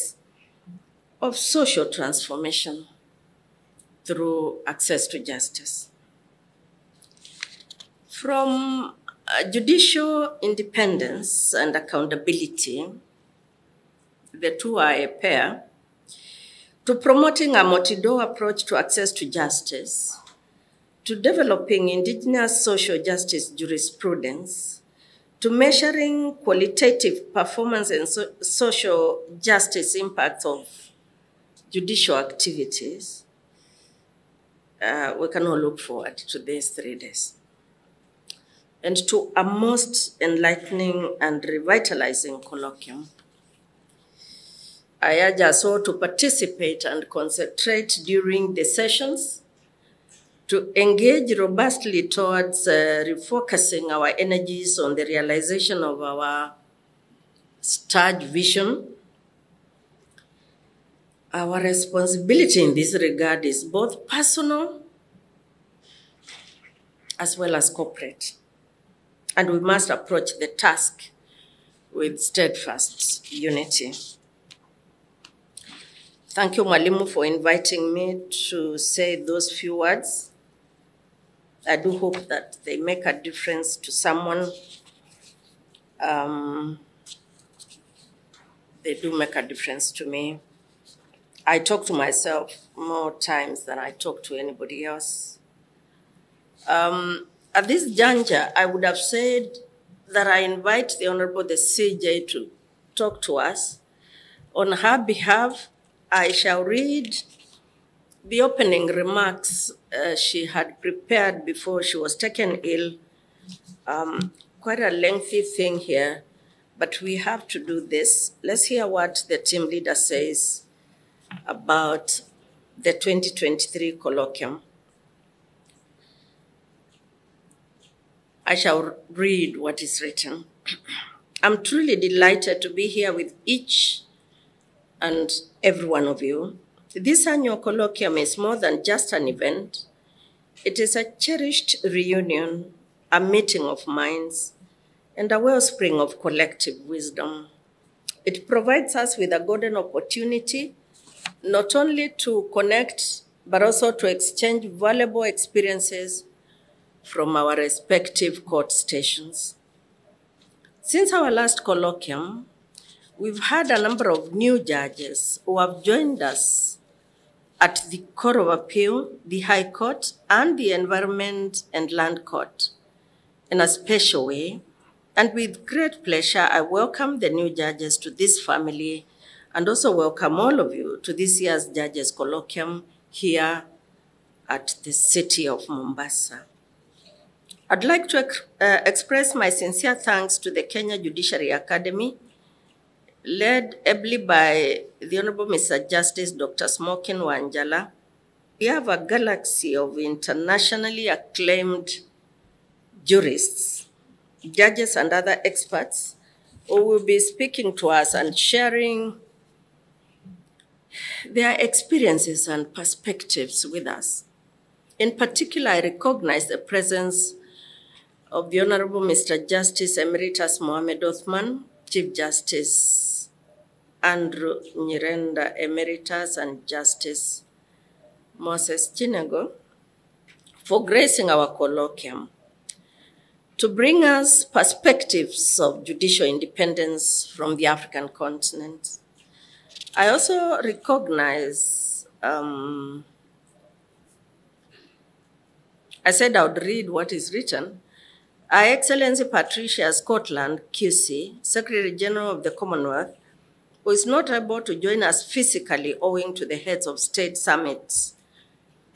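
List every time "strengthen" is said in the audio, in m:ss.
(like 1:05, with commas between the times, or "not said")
not said.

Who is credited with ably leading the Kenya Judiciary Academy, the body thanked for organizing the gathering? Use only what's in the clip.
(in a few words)
Dr. Smokin Wanjala.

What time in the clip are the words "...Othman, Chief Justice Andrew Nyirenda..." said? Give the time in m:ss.
3:41.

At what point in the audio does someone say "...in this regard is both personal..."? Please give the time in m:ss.
1:02.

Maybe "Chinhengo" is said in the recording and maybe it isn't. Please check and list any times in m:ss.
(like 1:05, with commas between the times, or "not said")
3:48.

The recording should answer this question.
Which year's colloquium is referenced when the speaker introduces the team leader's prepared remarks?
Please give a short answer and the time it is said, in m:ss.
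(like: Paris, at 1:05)
2023, at 2:02.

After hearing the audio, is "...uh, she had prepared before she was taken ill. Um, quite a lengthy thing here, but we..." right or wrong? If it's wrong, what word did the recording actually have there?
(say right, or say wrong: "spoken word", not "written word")
right.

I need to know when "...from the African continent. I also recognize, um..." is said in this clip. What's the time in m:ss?
3:57.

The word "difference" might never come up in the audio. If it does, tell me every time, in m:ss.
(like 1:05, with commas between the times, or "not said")
1:23, 1:29.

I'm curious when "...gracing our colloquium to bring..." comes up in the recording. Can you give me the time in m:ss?
3:50.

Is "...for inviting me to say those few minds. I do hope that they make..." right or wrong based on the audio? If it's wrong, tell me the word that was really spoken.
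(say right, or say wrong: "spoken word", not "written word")
wrong: "words", not "minds".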